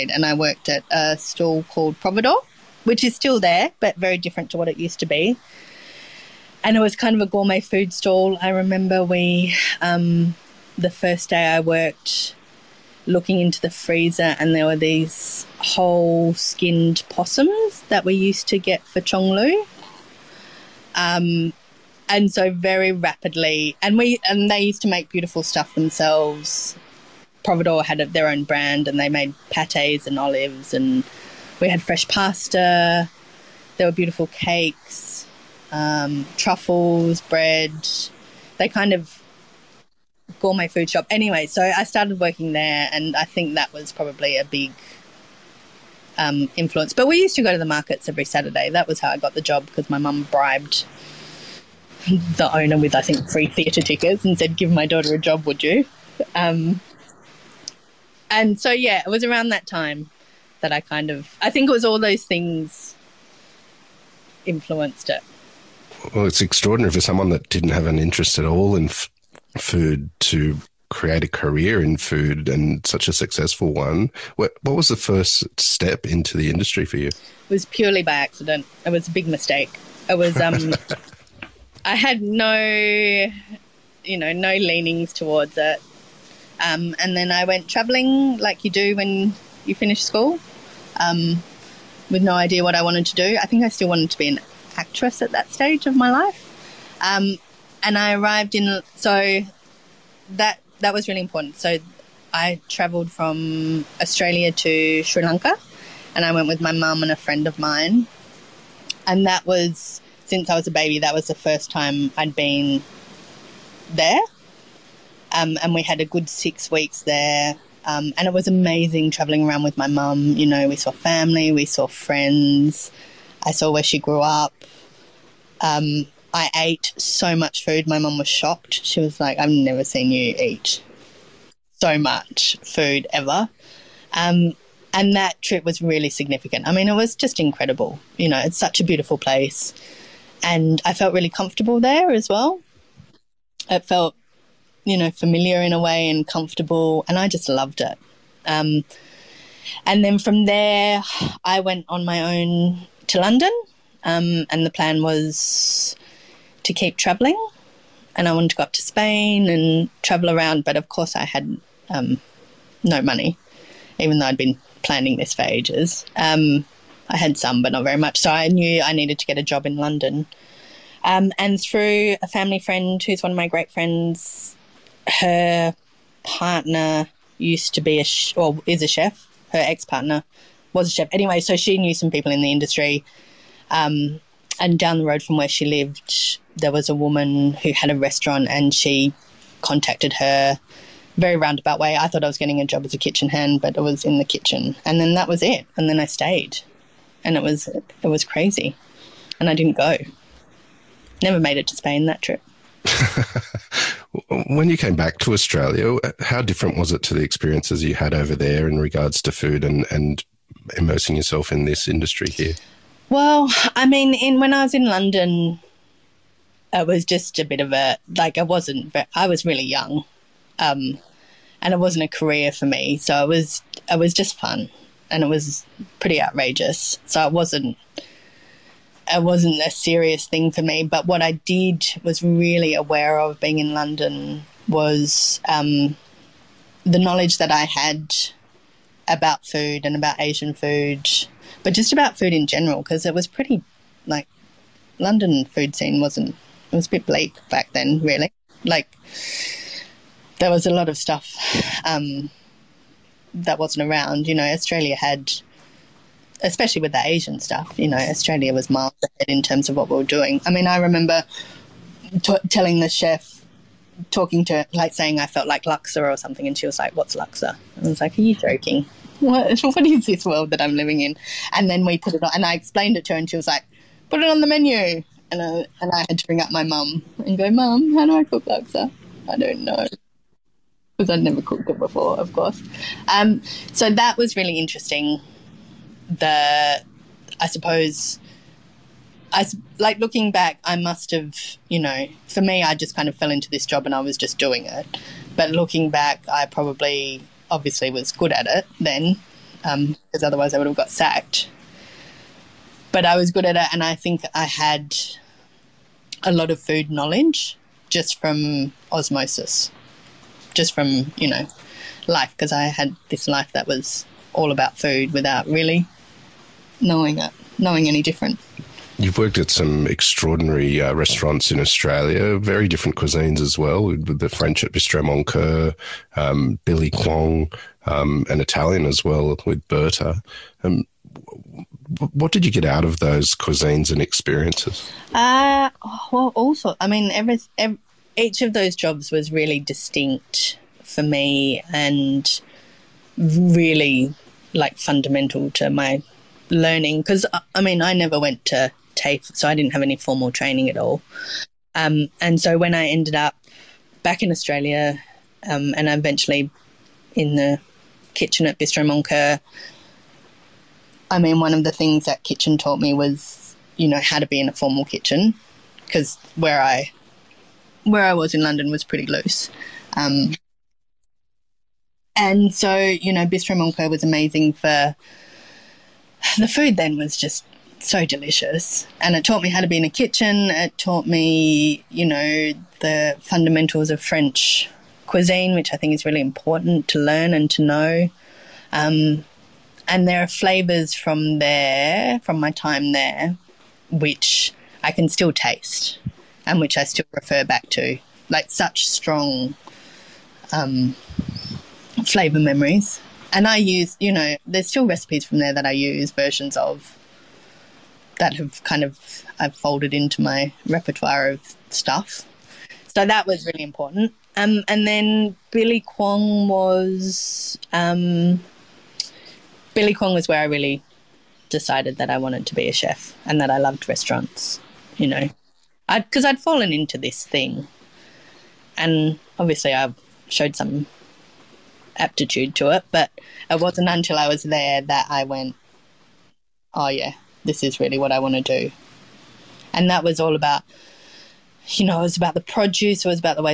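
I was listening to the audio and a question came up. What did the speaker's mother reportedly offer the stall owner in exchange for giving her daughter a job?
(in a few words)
Free theatre tickets.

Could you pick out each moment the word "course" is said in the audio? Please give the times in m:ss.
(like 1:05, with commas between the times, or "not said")
2:40, 4:42.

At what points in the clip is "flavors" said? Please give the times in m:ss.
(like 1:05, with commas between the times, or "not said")
6:30, 6:42.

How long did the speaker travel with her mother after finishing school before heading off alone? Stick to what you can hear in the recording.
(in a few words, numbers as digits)
Six weeks.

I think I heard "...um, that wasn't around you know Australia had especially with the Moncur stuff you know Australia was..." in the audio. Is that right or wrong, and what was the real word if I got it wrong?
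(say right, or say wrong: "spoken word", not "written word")
wrong: "Asian", not "Moncur".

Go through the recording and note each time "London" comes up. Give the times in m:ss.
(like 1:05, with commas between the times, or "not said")
2:33, 2:49, 3:34, 3:53, 4:04, 6:08.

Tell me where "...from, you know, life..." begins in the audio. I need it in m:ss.
5:10.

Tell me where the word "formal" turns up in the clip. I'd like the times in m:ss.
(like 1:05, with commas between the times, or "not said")
5:49, 6:04.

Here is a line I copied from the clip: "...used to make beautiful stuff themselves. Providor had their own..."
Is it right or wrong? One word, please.
right.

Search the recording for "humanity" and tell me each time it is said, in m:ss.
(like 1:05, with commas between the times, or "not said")
not said.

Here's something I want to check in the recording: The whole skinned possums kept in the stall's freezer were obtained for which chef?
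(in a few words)
Cheong Liew.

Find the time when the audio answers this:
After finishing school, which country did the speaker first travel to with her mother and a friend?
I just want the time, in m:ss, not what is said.
1:45.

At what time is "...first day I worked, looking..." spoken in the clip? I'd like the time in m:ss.
0:10.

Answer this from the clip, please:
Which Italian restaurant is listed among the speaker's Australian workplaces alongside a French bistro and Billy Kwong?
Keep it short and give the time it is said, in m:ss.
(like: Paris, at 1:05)
Berta, at 5:29.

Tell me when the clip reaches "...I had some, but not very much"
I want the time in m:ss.
2:47.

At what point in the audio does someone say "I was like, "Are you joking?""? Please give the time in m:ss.
4:27.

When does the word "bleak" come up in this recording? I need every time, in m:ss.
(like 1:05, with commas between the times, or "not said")
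4:07.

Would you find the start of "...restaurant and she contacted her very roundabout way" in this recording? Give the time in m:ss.
3:07.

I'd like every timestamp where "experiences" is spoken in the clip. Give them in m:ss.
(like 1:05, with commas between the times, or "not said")
3:27, 5:34.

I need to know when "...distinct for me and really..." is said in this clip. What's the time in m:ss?
5:39.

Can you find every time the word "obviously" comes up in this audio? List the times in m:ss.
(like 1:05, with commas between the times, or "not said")
4:57, 7:09.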